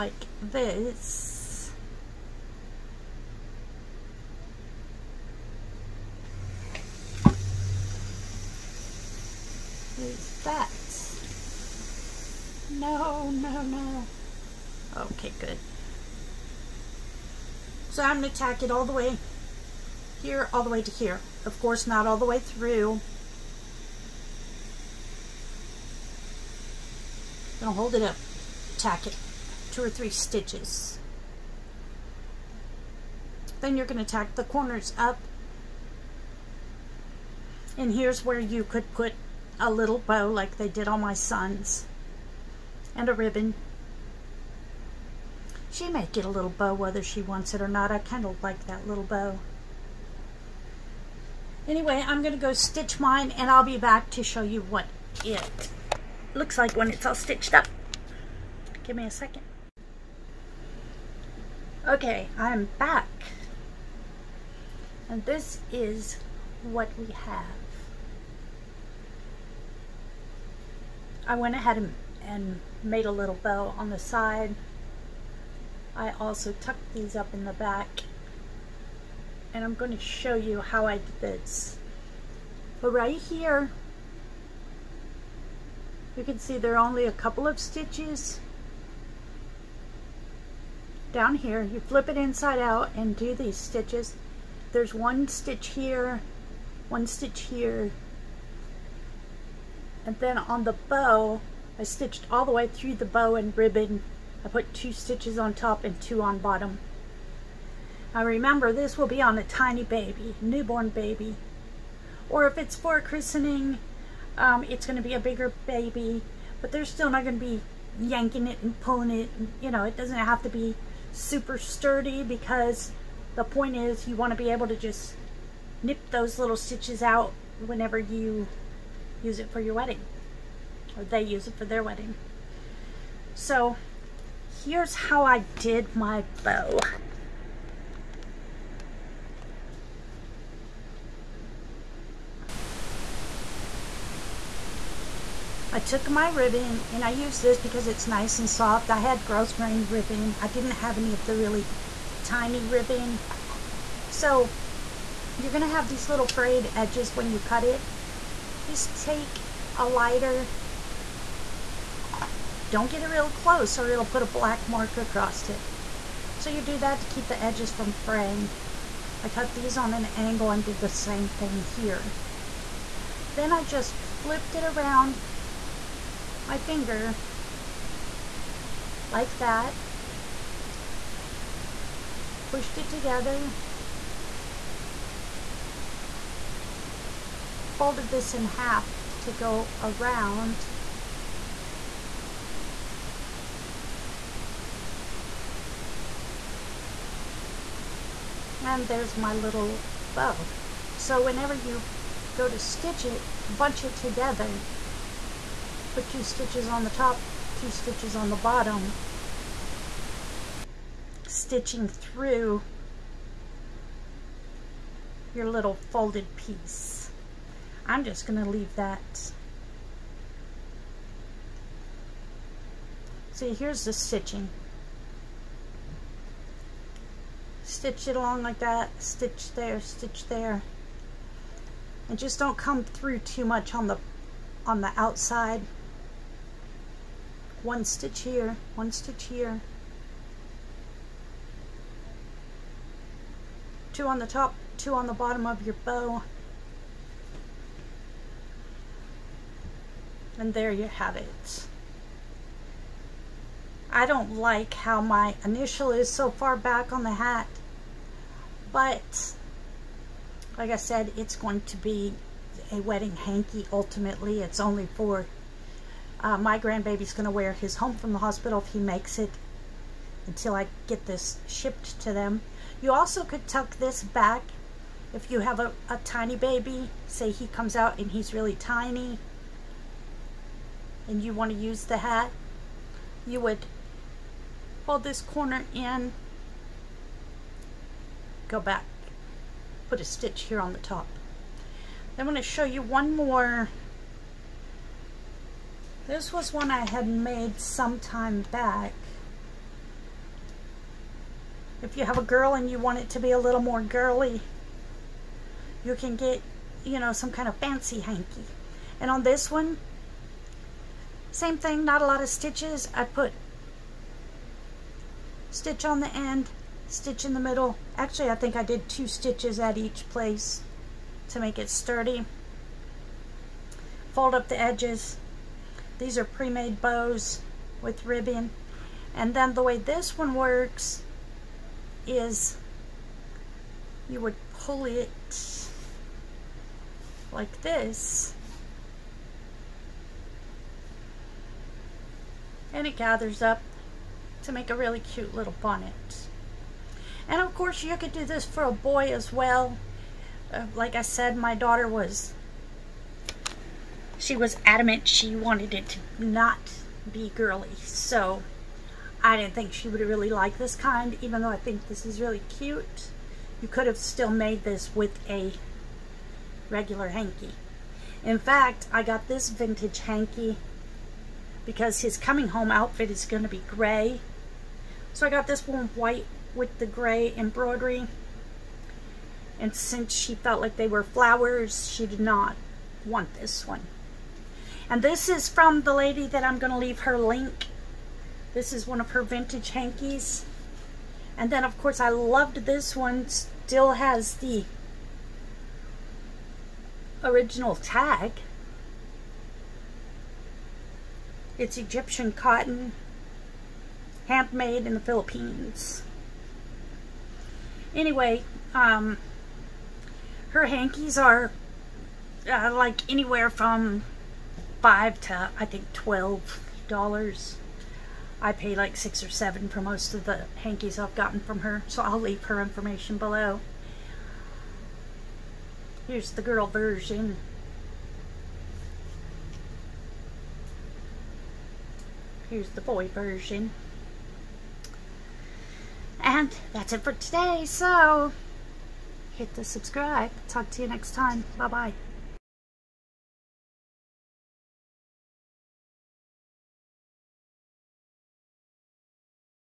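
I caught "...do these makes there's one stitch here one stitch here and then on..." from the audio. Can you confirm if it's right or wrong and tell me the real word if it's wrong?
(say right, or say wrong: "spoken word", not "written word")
wrong: "stitches", not "makes".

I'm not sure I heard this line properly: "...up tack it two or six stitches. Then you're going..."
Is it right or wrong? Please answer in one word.
wrong.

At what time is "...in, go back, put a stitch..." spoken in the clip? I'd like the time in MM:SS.
04:45.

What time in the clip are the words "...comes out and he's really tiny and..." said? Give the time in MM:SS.
04:37.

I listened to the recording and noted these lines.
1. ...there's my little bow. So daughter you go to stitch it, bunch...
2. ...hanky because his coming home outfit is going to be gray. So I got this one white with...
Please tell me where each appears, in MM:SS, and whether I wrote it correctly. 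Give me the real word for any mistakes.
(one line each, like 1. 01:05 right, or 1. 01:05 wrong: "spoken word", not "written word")
1. 03:18 wrong: "whenever", not "daughter"
2. 06:10 right.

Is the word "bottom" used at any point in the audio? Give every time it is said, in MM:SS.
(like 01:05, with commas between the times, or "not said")
01:46, 03:28, 04:05.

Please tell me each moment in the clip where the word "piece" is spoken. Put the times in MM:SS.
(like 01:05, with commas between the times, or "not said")
03:36.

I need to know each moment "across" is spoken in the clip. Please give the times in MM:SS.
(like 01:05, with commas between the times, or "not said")
02:44.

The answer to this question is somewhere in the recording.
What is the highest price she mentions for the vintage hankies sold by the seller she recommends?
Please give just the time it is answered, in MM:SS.
06:55.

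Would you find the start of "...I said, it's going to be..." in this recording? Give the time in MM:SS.
04:20.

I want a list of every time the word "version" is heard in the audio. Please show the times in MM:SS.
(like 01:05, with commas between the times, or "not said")
07:06, 07:13.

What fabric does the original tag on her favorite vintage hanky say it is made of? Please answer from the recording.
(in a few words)
Egyptian cotton.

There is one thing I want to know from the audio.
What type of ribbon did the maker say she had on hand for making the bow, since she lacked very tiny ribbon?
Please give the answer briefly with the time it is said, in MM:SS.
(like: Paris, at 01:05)
Grosgrain ribbon, at 02:29.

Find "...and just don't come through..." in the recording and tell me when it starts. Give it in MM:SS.
03:52.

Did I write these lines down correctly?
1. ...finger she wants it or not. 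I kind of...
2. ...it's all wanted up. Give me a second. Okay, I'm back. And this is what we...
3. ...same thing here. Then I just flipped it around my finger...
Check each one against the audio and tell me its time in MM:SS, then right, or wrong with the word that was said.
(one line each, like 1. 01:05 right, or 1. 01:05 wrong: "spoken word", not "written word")
1. 00:46 wrong: "whether", not "finger"
2. 00:56 wrong: "stitched", not "wanted"
3. 02:50 right.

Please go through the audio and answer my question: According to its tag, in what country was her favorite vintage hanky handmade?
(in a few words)
The Philippines.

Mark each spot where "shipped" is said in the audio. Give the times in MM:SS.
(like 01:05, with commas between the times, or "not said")
04:31.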